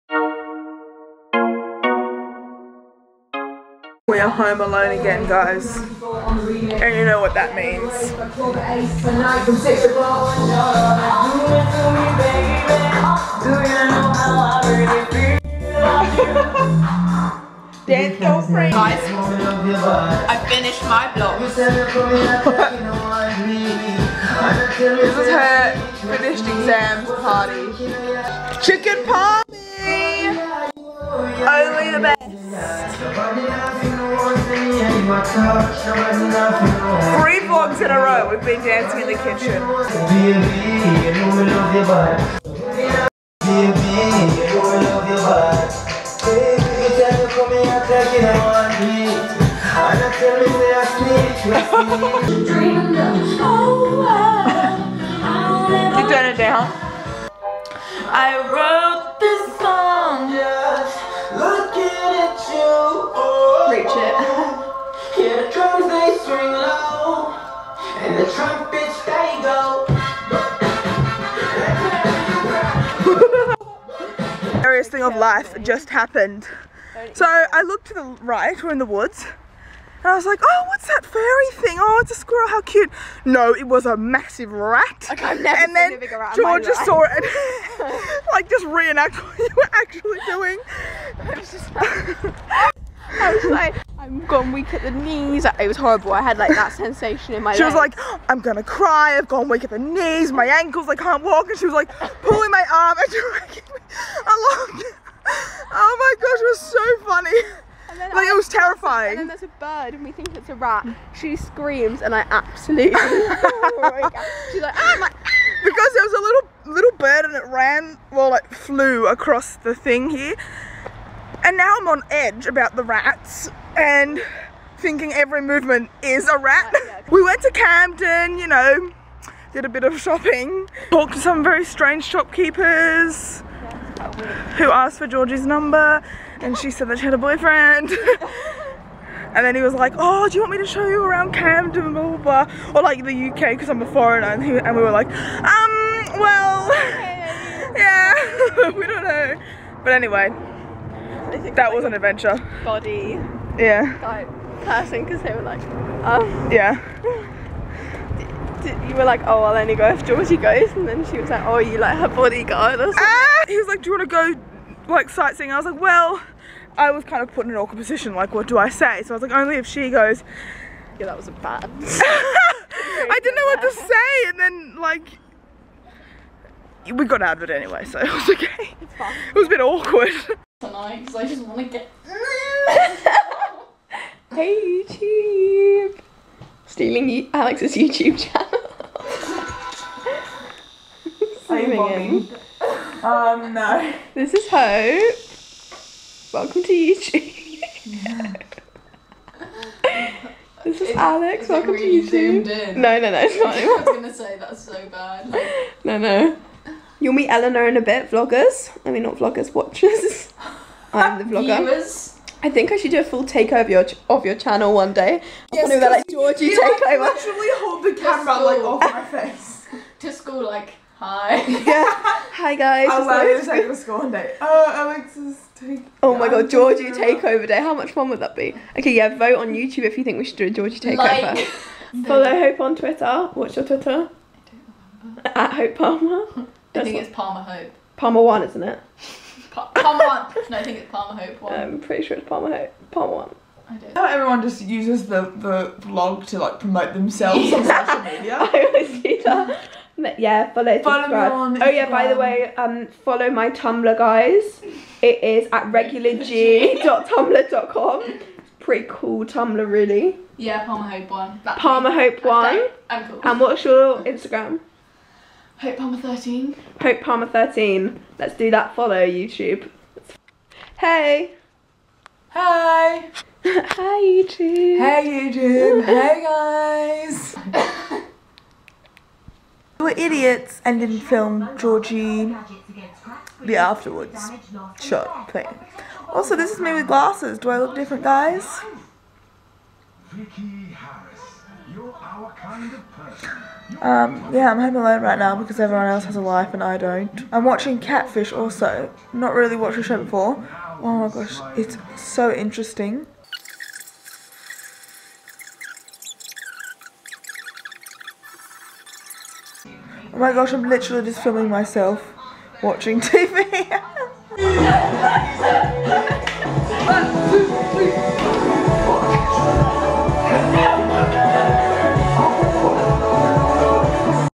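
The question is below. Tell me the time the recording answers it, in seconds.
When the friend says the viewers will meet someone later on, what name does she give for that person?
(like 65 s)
207 s.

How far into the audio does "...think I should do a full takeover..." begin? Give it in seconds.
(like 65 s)
212 s.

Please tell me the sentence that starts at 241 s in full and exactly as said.
I'm pretty sure it's Palmer Hope.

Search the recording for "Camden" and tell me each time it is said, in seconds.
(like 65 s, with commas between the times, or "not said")
127 s, 141 s.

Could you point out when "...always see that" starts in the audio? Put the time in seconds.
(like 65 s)
248 s.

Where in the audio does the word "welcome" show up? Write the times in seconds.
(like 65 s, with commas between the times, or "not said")
196 s, 201 s.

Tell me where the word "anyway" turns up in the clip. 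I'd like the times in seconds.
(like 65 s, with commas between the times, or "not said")
149 s, 177 s.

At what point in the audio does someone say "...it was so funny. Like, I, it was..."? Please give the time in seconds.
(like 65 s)
106 s.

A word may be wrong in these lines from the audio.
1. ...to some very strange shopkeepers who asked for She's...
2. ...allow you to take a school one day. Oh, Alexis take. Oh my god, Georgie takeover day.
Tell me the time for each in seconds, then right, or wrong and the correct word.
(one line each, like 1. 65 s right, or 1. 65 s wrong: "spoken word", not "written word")
1. 131 s wrong: "Georgie", not "She"
2. 223 s right.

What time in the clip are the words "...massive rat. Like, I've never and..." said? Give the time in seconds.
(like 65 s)
83 s.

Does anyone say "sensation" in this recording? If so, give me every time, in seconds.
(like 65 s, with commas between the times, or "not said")
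96 s.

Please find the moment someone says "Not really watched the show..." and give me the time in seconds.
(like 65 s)
299 s.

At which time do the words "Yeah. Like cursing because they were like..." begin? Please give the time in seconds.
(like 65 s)
153 s.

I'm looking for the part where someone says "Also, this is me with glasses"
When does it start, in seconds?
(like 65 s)
286 s.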